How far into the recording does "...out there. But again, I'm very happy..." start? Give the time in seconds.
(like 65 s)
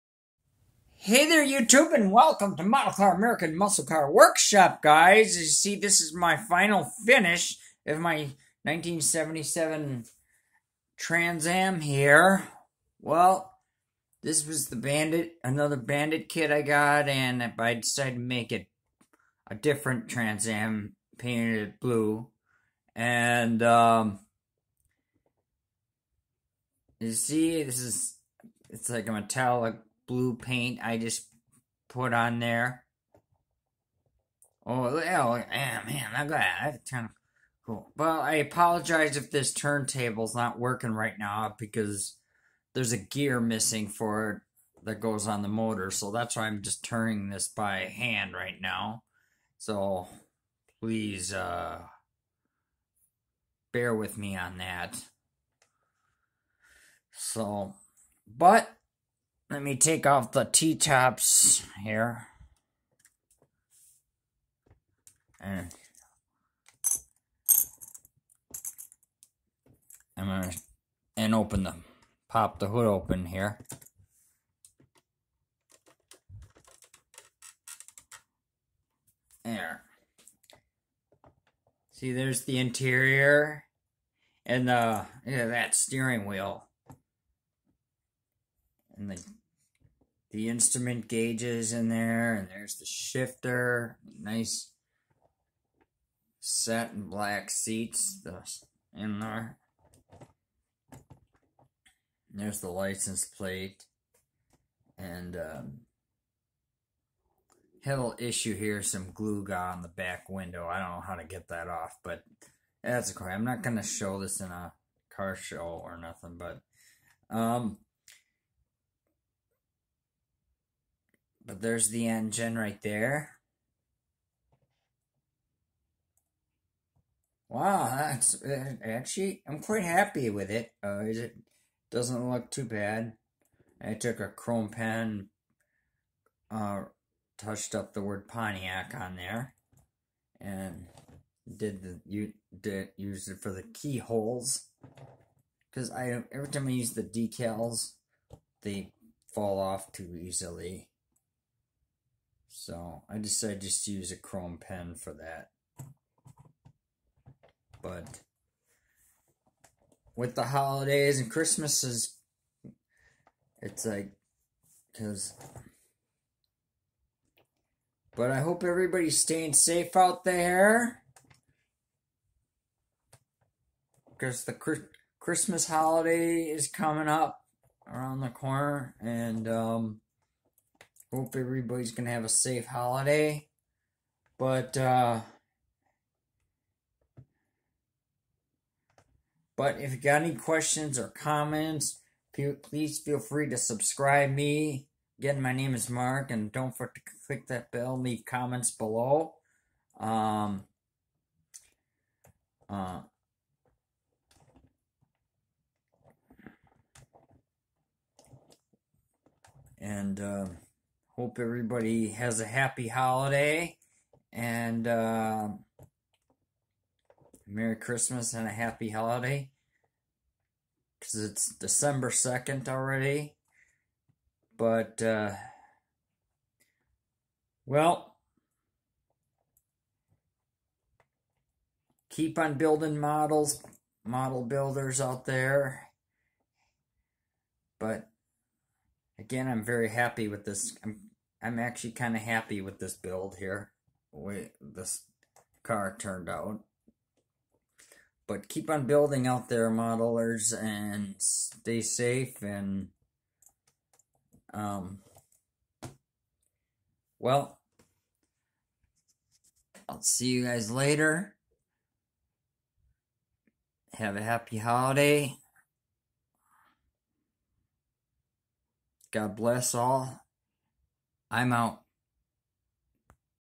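235 s.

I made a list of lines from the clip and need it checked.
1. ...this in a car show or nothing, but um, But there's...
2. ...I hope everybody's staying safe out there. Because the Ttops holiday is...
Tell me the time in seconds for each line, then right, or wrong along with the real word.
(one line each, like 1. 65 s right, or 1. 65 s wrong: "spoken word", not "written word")
1. 114 s right
2. 168 s wrong: "Christmas", not "Ttops".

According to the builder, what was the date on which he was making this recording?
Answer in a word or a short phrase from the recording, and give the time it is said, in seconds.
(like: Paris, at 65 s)
December 2nd, at 221 s.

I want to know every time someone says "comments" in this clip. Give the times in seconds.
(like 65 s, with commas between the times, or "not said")
191 s, 198 s.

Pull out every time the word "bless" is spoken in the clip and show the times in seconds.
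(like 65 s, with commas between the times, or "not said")
269 s.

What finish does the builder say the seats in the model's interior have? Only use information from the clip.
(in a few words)
satin black.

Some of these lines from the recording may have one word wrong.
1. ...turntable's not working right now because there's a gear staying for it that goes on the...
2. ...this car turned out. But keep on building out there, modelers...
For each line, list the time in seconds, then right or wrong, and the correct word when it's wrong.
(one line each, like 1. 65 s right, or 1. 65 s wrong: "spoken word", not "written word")
1. 39 s wrong: "missing", not "staying"
2. 244 s right.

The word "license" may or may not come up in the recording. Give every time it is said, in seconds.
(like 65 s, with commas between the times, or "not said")
102 s.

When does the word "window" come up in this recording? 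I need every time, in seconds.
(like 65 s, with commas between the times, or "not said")
110 s.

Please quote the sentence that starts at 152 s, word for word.
So I decided just to use a chrome pen for that.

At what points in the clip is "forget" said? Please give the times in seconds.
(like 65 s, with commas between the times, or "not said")
196 s.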